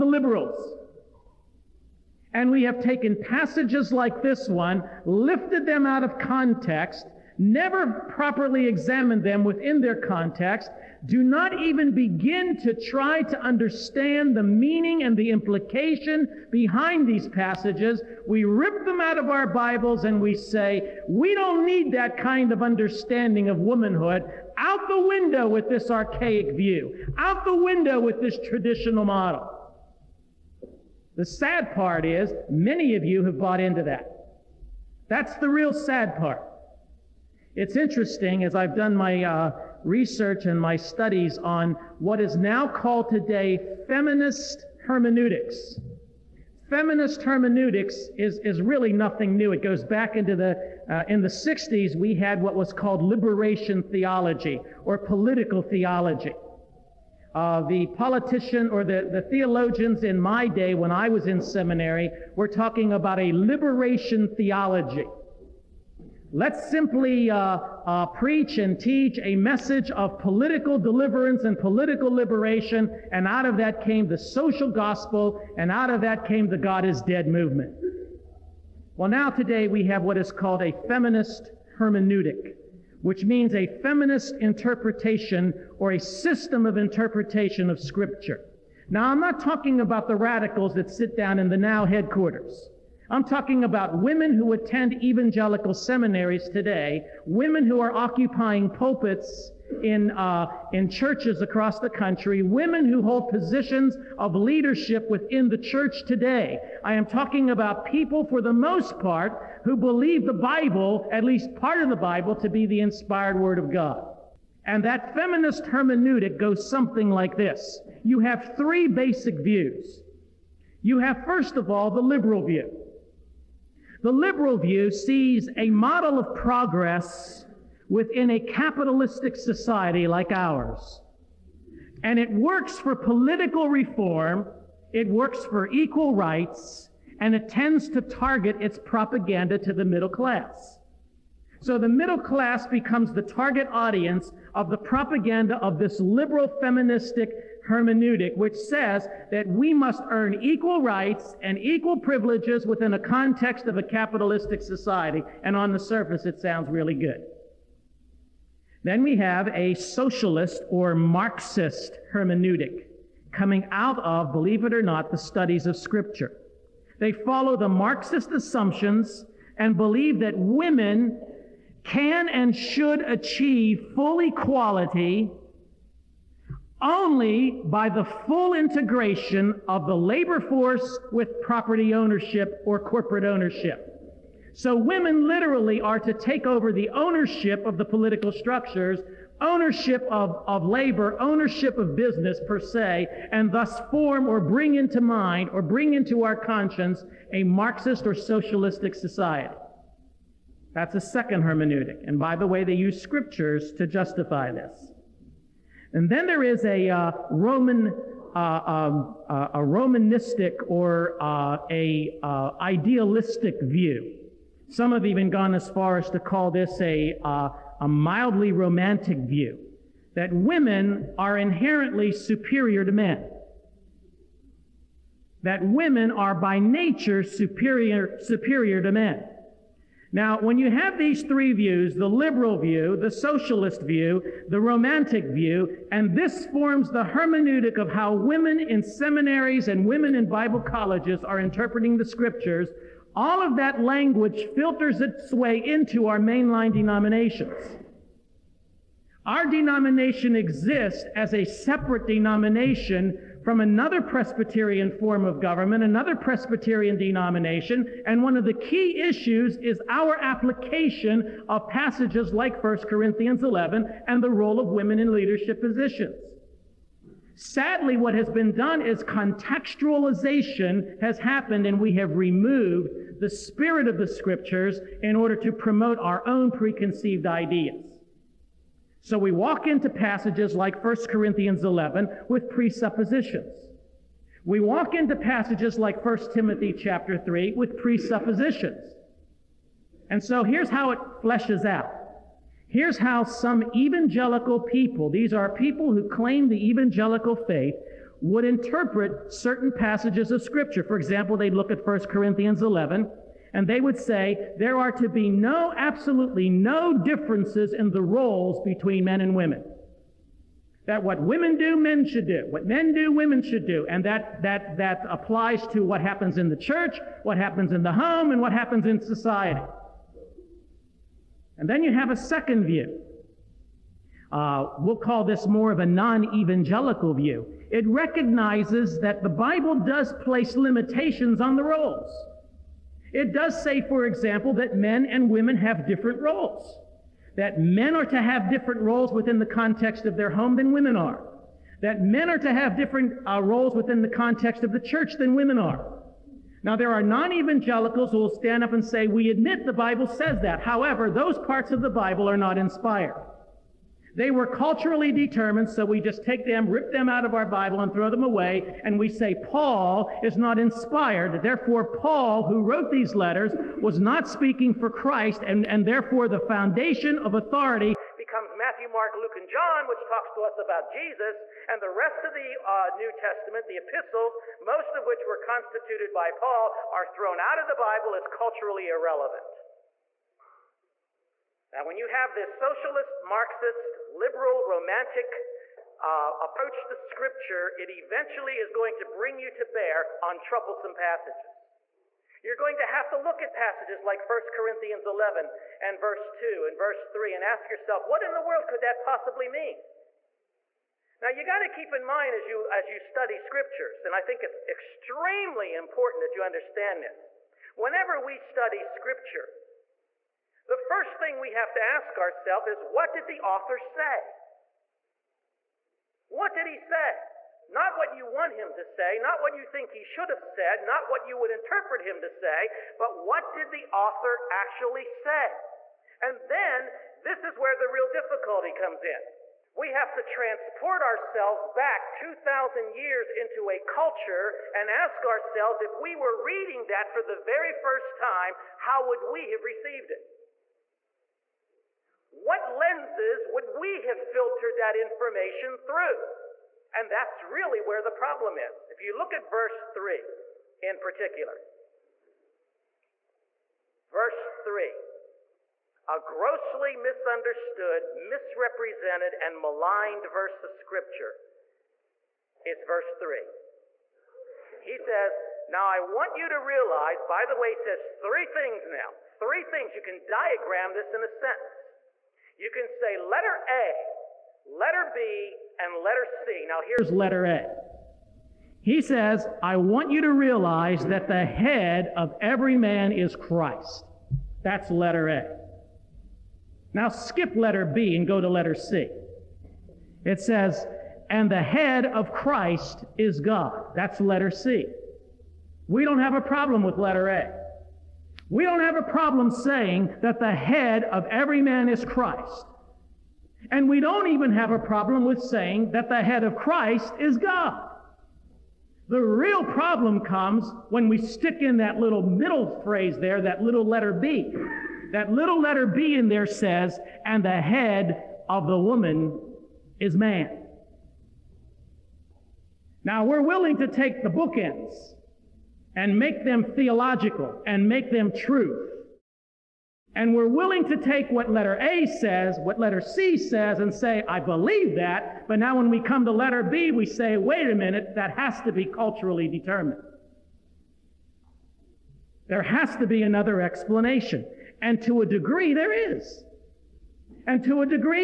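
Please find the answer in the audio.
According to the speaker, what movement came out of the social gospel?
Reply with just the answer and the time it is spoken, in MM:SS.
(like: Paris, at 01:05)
God is dead movement, at 01:16.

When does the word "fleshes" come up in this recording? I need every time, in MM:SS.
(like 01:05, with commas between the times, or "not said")
04:51.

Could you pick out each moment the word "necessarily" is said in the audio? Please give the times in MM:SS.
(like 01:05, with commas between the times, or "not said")
not said.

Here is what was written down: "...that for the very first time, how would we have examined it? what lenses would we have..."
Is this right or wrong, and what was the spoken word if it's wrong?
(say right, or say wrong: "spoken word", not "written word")
wrong: "received", not "examined".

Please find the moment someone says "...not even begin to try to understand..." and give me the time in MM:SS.
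00:11.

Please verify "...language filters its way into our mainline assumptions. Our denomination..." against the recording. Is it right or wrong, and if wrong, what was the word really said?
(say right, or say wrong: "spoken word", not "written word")
wrong: "denominations", not "assumptions".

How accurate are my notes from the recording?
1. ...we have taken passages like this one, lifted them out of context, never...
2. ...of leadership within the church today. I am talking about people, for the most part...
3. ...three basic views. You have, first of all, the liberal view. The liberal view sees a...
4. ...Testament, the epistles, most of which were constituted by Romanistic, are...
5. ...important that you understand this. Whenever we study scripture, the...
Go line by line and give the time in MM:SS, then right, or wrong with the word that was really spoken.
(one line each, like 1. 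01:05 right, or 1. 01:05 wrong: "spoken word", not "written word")
1. 00:02 right
2. 01:44 right
3. 01:58 right
4. 06:13 wrong: "Paul", not "Romanistic"
5. 06:45 right.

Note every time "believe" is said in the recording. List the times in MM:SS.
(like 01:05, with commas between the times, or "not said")
01:49, 02:44, 02:49, 08:54.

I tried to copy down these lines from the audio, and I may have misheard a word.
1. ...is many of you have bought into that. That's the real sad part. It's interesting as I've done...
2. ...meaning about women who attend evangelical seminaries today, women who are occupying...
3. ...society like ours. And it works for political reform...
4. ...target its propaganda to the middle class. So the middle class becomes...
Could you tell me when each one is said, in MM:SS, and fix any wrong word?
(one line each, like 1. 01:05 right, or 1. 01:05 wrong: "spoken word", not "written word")
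1. 00:32 right
2. 01:33 wrong: "talking", not "meaning"
3. 02:09 right
4. 02:18 right.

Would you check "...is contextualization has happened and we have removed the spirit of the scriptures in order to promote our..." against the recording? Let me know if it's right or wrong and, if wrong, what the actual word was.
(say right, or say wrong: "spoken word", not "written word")
right.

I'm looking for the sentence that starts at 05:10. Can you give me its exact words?
That what women do, men should do.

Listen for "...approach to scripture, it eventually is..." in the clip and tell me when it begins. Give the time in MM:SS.
06:26.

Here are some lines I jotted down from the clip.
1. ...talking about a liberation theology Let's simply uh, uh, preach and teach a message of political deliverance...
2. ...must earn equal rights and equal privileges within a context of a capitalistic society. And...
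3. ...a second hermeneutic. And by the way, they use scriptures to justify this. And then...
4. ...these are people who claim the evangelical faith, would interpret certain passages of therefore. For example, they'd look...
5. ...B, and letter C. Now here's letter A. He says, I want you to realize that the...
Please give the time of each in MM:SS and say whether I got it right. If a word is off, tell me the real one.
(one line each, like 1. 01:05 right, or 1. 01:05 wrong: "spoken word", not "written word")
1. 01:02 right
2. 02:29 right
3. 03:20 right
4. 04:55 wrong: "scripture", not "therefore"
5. 07:55 right.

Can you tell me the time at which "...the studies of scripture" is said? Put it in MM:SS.
02:45.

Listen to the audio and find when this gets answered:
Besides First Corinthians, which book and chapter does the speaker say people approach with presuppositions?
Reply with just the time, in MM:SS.
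04:46.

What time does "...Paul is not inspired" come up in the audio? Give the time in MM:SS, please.
05:59.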